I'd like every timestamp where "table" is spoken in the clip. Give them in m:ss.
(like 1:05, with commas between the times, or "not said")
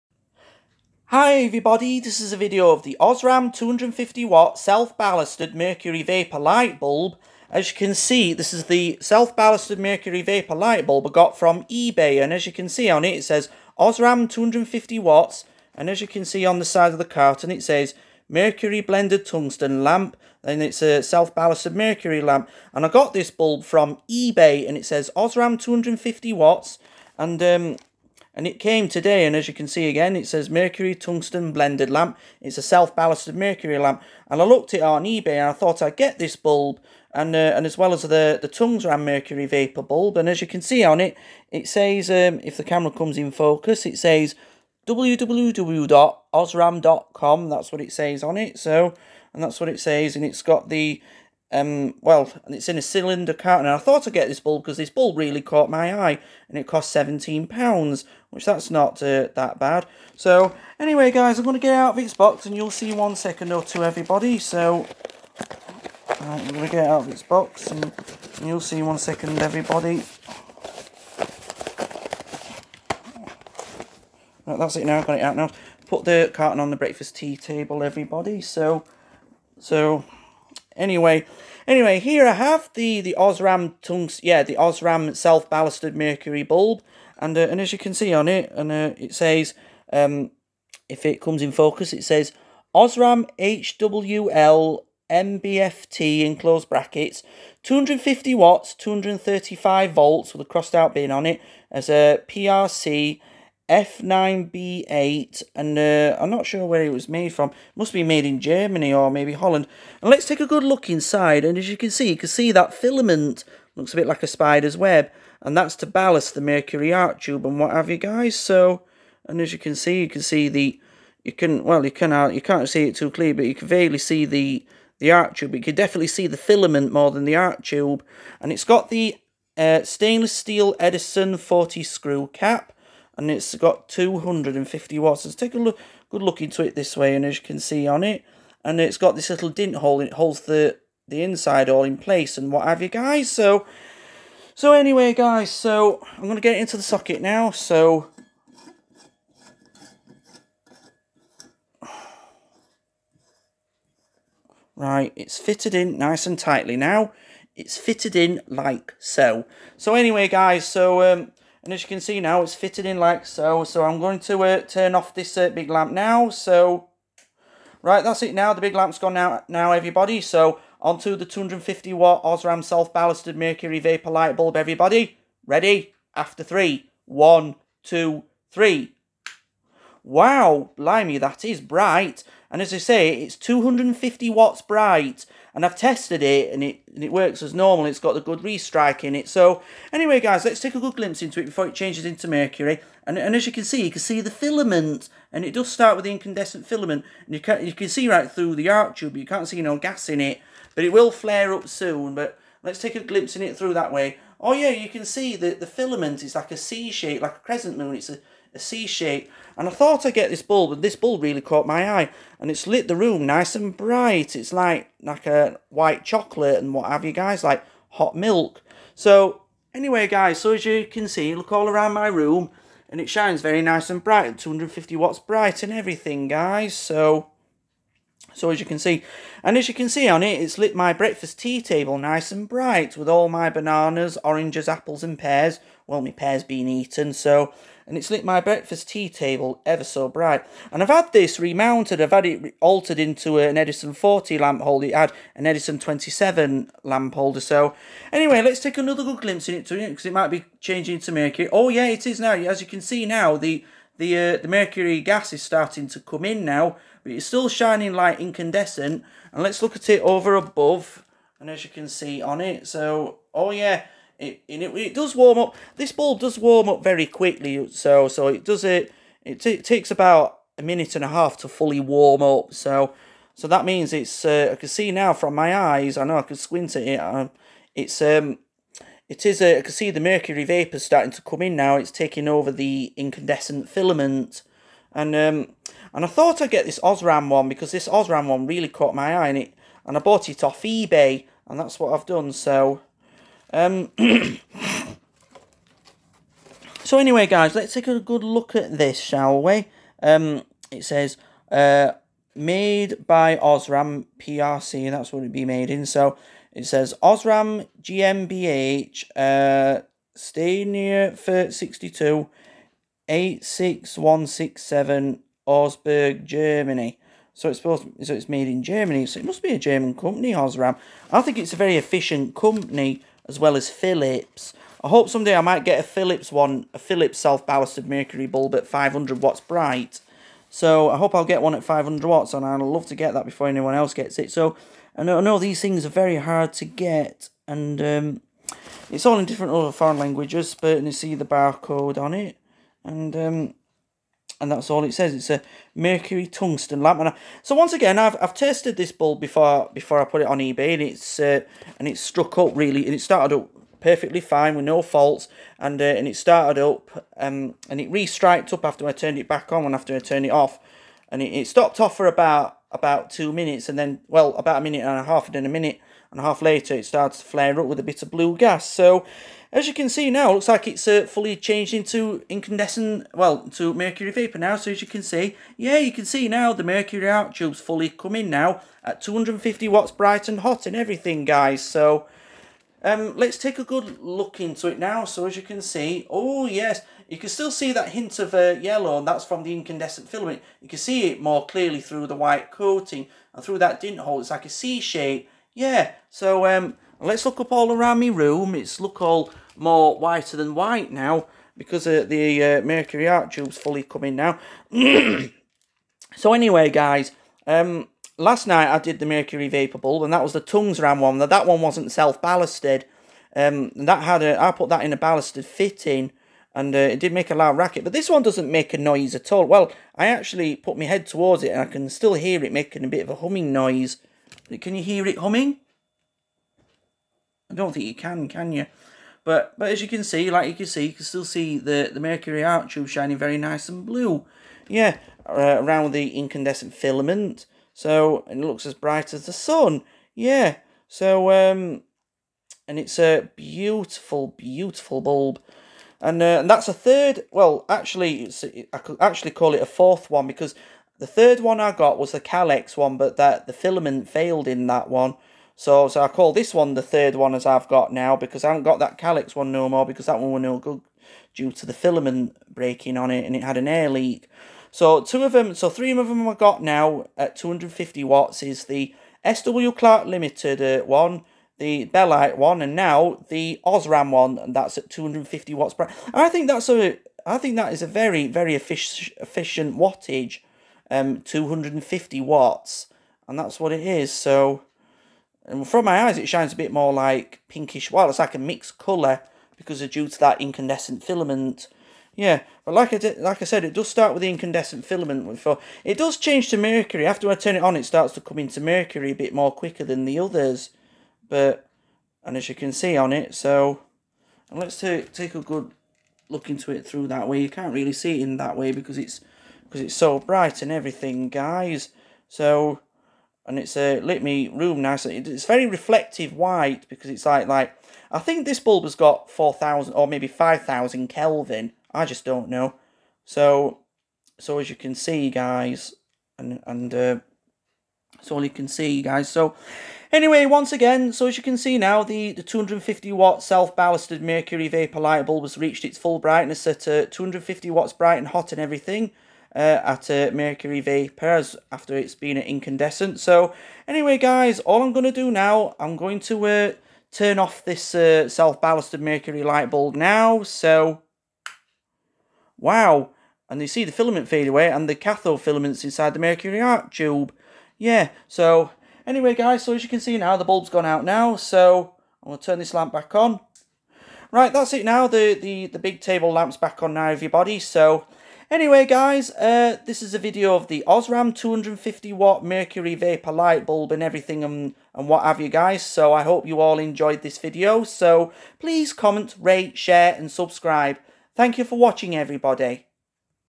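1:17, 3:51, 3:59, 9:25.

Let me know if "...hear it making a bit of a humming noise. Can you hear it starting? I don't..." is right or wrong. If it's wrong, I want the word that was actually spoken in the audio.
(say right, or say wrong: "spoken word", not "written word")
wrong: "humming", not "starting".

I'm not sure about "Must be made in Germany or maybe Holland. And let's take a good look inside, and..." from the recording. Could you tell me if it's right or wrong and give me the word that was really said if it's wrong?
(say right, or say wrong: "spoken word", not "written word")
right.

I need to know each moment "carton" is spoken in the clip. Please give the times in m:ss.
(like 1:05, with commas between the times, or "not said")
0:17, 0:53, 1:16.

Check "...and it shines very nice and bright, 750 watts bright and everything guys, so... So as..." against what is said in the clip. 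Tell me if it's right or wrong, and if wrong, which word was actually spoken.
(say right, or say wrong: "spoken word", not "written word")
wrong: "250", not "750".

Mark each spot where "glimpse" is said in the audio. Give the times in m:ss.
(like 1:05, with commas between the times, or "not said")
3:10, 3:23, 4:09.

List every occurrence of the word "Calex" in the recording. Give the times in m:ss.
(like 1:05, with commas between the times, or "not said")
7:32, 7:38.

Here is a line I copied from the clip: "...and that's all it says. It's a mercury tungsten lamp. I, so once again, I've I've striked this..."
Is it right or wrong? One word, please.
wrong.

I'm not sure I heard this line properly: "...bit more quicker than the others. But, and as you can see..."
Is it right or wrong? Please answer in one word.
right.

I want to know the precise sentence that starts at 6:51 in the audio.
That that one wasn't self ballasted.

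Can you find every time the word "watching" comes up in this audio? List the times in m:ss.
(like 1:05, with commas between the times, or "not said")
9:41.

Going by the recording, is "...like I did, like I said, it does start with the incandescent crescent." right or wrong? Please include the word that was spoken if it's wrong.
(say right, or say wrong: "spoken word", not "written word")
wrong: "filament", not "crescent".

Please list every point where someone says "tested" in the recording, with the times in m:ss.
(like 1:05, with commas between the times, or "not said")
3:05, 5:48.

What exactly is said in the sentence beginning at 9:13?
And you see the filament fade away and the cathode filaments inside the mercury arc tube.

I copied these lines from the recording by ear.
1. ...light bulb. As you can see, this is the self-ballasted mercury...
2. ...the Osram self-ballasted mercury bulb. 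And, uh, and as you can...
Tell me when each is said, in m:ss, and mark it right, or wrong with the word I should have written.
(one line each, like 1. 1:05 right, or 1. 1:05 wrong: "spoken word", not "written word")
1. 0:06 right
2. 1:24 right.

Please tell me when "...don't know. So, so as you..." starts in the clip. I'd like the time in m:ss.
8:42.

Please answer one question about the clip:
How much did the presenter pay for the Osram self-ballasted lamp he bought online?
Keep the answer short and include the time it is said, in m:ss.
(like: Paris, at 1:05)
£17, at 0:56.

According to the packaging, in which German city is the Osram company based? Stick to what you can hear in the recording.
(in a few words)
Augsburg.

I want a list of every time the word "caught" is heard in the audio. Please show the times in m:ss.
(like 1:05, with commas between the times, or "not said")
0:55, 3:31, 4:48.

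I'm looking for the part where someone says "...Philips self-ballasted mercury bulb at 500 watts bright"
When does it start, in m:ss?
5:26.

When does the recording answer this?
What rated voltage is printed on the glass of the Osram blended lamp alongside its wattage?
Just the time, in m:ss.
1:38.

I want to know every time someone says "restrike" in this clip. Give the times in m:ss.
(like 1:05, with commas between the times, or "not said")
3:08.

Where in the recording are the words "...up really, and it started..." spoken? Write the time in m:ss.
5:52.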